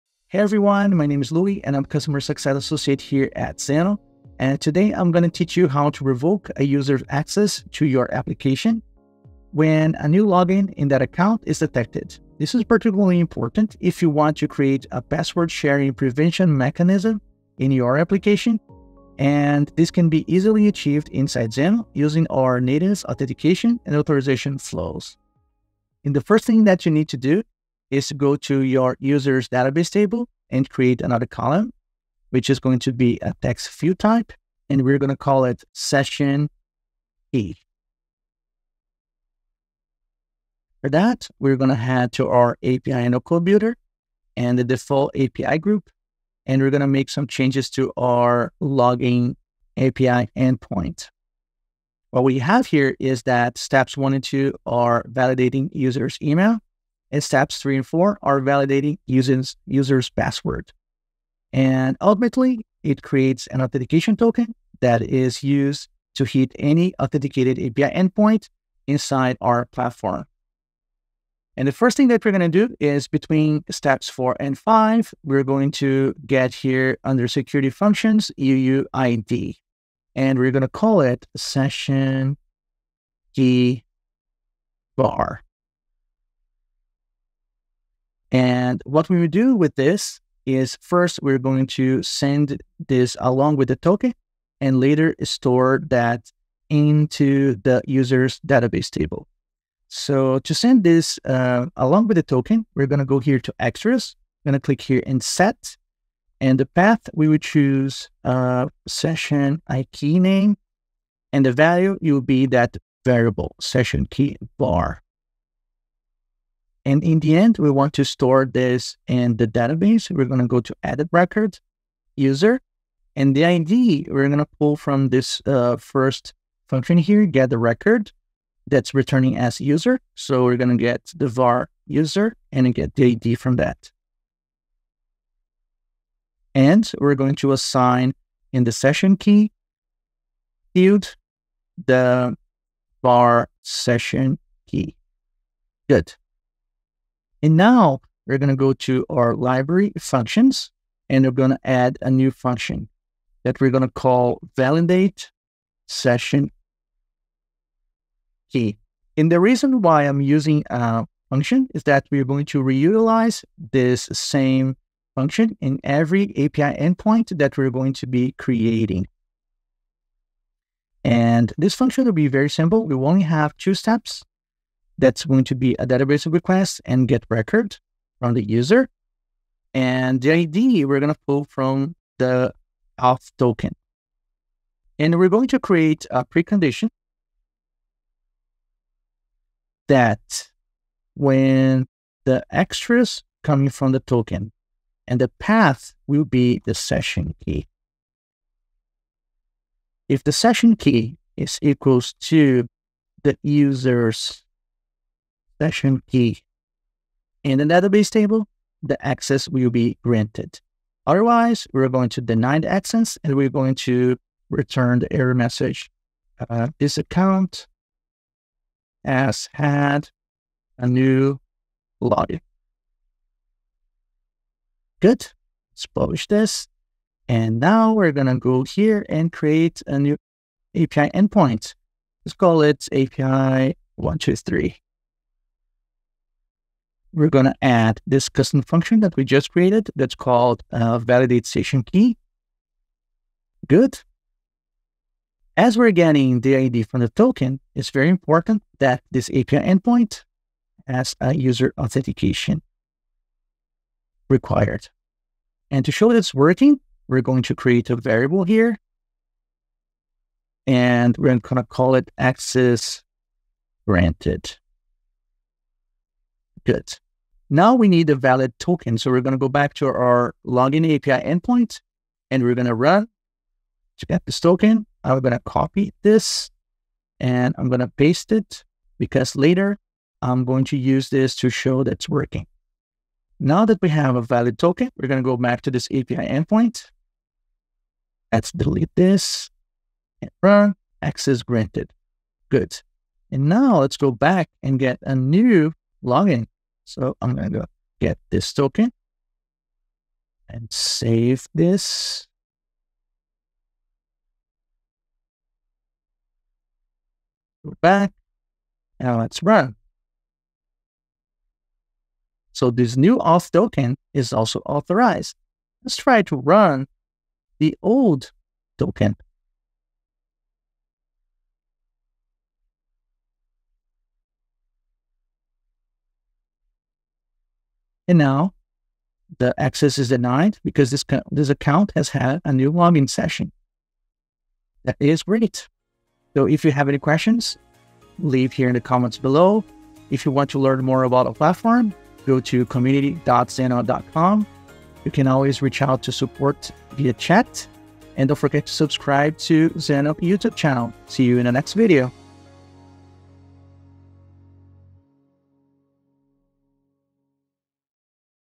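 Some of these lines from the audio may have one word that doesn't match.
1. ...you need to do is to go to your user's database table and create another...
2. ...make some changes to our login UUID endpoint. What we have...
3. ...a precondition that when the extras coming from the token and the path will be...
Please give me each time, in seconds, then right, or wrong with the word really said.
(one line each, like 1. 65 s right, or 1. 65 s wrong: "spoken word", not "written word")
1. 26 s right
2. 46 s wrong: "API", not "UUID"
3. 186 s right.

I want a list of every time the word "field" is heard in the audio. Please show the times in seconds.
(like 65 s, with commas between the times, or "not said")
140 s.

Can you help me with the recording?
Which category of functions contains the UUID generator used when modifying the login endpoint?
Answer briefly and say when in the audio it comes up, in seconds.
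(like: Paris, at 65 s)
security functions, at 77 s.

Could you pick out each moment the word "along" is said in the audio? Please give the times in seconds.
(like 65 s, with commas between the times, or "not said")
93 s, 101 s.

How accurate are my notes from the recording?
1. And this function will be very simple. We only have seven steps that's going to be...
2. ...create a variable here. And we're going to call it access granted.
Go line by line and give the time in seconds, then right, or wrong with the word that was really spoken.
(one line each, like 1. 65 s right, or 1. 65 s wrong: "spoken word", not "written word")
1. 171 s wrong: "two", not "seven"
2. 257 s right.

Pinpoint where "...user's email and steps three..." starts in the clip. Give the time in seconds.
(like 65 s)
55 s.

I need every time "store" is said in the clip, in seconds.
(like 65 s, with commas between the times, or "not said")
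95 s, 118 s.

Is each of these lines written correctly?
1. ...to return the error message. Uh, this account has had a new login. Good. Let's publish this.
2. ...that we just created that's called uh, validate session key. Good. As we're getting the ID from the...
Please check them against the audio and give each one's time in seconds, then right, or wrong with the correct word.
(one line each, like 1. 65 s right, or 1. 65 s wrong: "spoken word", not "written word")
1. 213 s right
2. 239 s right.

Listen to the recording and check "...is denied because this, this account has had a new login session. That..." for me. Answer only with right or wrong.
right.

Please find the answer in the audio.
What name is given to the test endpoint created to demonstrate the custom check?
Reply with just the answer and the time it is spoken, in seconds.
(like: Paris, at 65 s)
API 123, at 232 s.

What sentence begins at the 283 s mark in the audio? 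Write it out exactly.
Now that we have a valid token, we're going to go back to this API endpoint.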